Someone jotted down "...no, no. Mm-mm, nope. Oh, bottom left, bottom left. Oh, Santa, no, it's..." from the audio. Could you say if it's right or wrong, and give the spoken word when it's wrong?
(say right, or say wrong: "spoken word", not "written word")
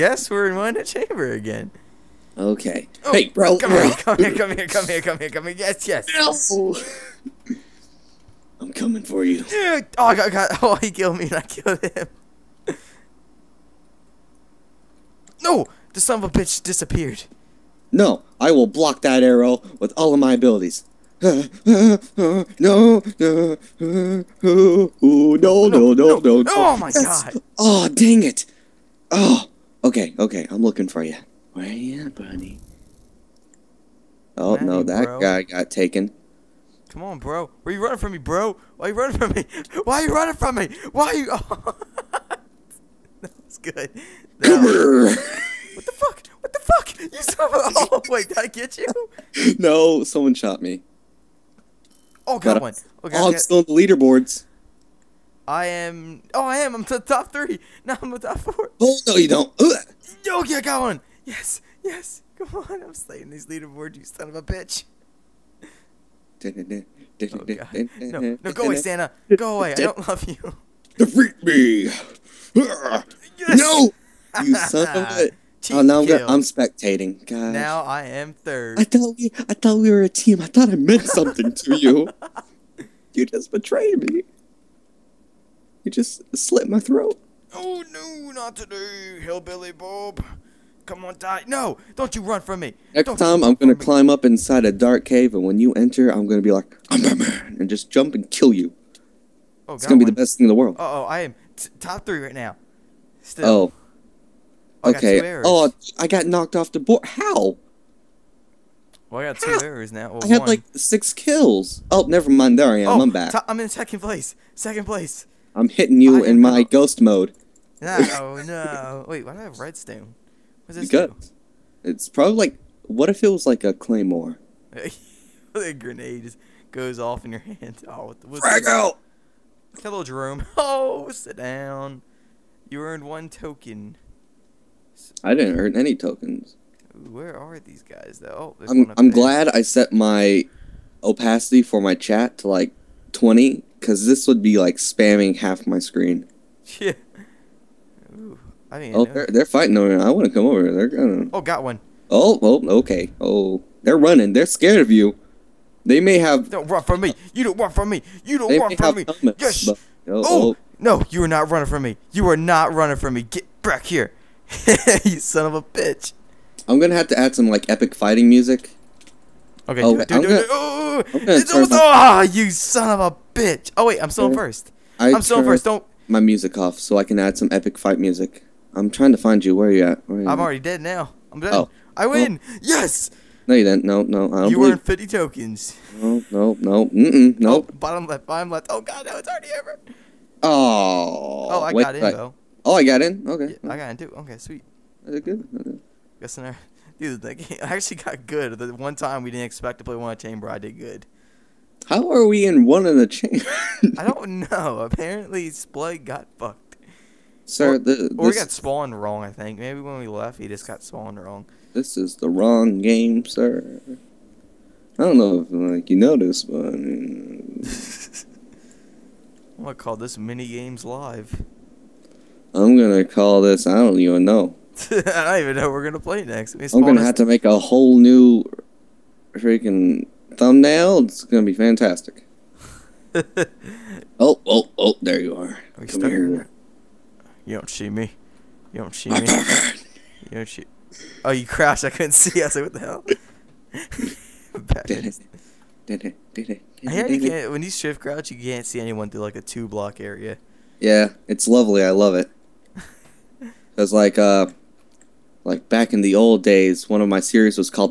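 wrong: "God", not "Santa".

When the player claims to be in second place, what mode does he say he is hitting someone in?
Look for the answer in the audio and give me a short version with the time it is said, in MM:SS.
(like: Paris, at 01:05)
ghost mode, at 01:56.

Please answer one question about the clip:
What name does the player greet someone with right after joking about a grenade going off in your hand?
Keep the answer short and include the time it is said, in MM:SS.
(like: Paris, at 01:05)
Jerome, at 02:10.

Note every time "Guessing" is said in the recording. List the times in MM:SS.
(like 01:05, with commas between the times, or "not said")
03:16.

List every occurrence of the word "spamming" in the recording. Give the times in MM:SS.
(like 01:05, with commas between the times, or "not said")
02:24.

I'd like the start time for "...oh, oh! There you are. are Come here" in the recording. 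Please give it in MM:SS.
03:54.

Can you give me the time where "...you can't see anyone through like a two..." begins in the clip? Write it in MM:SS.
04:08.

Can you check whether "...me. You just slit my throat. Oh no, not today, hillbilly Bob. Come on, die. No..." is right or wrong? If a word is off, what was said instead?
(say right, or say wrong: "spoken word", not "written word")
right.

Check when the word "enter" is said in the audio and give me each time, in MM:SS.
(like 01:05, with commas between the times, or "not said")
01:35.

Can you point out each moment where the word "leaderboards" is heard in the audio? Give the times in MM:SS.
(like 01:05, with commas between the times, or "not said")
00:53, 01:03.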